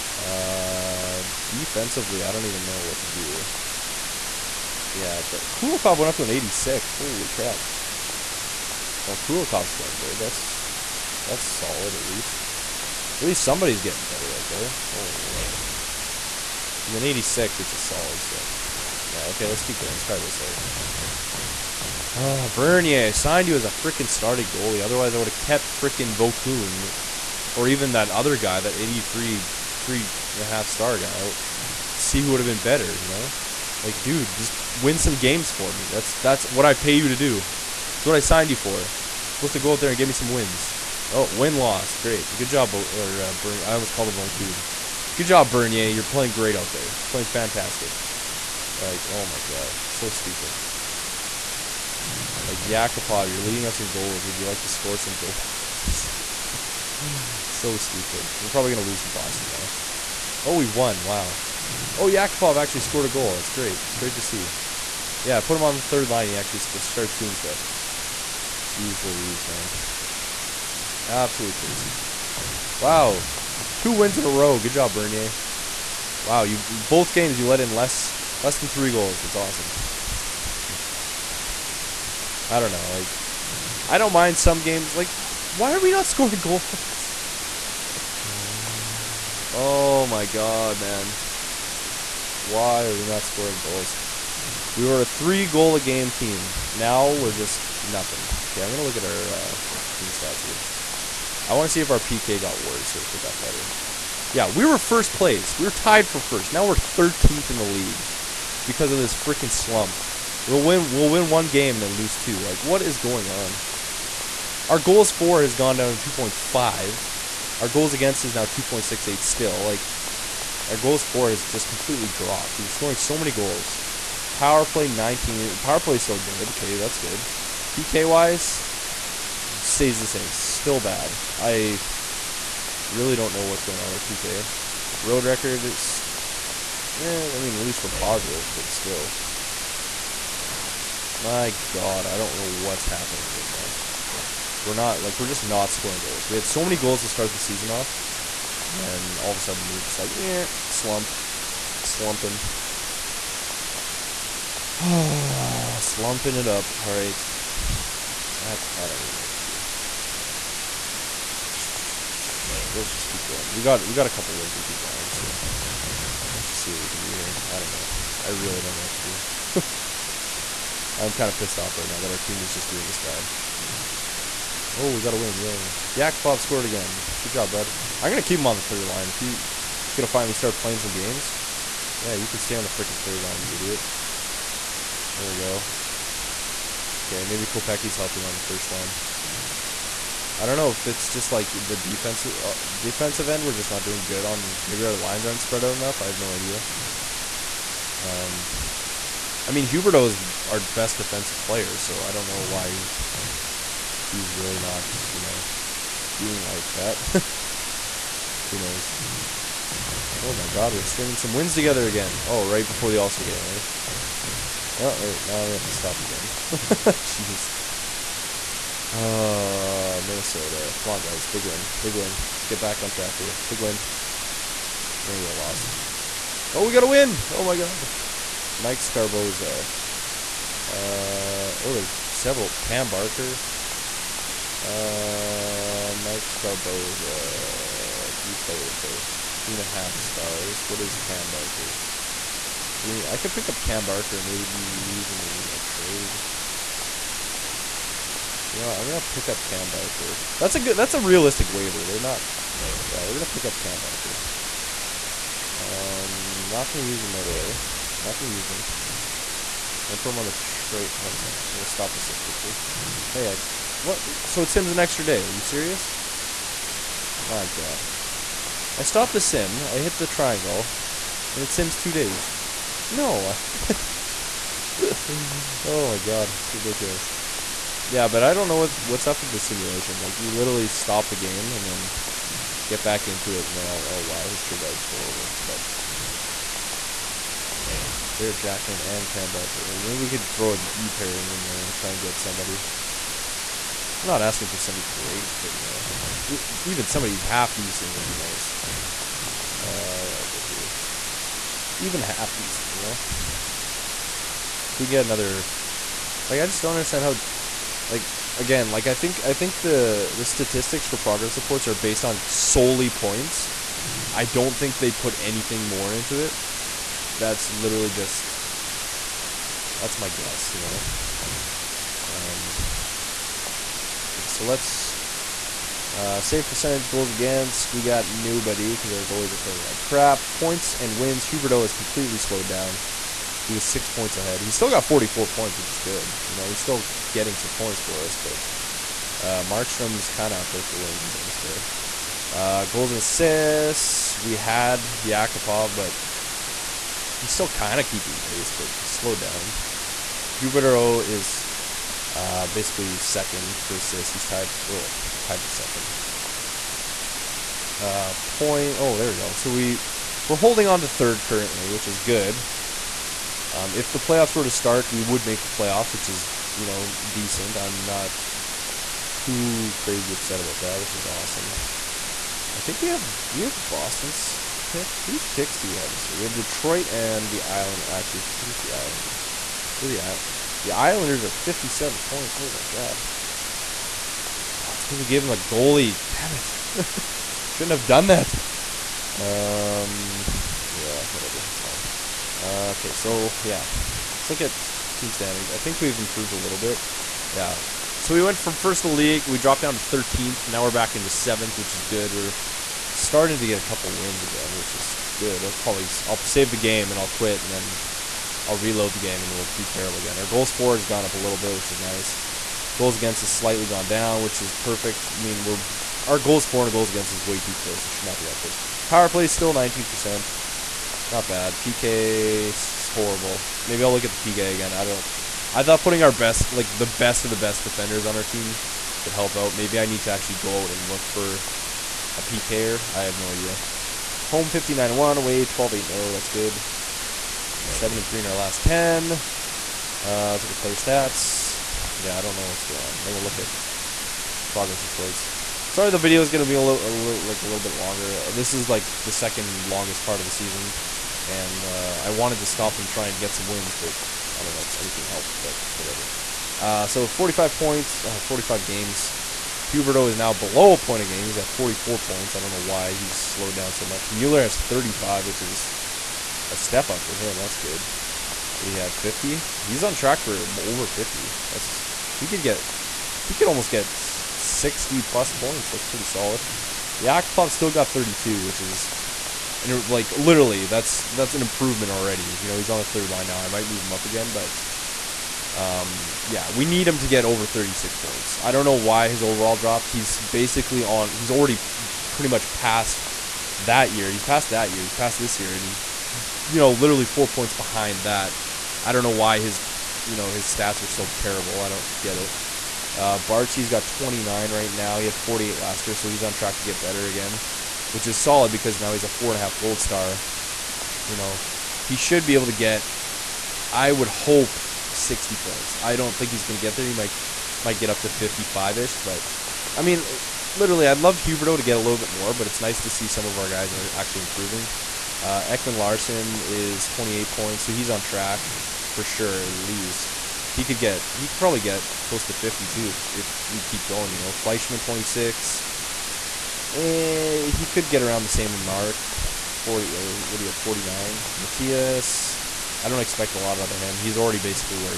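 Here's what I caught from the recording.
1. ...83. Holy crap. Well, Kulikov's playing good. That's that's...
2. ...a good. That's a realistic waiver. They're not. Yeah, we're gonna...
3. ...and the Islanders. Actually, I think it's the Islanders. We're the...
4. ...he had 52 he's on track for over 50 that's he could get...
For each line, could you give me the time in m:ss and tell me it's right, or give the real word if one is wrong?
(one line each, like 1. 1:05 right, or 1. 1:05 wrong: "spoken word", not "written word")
1. 0:06 wrong: "86", not "83"
2. 4:10 right
3. 6:16 right
4. 7:48 wrong: "50", not "52".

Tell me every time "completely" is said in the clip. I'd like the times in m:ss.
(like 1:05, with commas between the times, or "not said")
2:01, 5:31.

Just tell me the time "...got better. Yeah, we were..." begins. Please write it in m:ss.
1:43.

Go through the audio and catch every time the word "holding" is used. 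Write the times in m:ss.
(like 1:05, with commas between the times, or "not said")
6:00.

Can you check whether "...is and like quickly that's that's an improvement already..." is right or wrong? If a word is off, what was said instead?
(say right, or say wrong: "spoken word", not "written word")
wrong: "literally", not "quickly".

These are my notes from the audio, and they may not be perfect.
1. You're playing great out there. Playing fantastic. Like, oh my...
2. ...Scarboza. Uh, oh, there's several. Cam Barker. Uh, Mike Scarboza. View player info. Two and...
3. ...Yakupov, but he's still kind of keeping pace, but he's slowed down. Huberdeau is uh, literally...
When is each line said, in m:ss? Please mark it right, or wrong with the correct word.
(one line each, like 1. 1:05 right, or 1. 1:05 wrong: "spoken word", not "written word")
1. 0:45 right
2. 3:48 right
3. 5:45 wrong: "basically", not "literally".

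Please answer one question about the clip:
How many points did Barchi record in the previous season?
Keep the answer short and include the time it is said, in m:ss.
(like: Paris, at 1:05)
48, at 8:25.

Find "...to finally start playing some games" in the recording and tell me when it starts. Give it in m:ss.
3:00.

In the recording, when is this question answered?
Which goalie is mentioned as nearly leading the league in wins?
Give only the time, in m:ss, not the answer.
5:39.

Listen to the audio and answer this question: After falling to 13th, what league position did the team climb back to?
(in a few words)
7th.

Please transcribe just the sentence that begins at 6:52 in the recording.
Goals against has slightly gone down, which is perfect.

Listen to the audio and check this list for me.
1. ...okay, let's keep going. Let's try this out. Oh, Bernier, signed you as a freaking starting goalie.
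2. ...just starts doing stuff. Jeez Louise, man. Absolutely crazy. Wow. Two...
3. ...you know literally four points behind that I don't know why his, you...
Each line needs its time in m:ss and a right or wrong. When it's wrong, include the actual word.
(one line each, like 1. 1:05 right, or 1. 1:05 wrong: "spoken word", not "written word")
1. 0:19 right
2. 1:06 right
3. 8:16 right.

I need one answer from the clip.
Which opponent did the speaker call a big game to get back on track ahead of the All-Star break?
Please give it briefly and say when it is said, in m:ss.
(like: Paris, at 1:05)
Minnesota, at 3:40.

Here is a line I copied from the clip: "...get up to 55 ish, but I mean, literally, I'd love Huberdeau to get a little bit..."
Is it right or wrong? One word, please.
right.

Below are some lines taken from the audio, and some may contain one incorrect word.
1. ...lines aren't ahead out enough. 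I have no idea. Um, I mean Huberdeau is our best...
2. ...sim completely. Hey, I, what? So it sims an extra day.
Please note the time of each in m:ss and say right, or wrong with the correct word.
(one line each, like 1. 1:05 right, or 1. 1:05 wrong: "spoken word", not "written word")
1. 3:14 wrong: "spread", not "ahead"
2. 4:22 wrong: "quickly", not "completely".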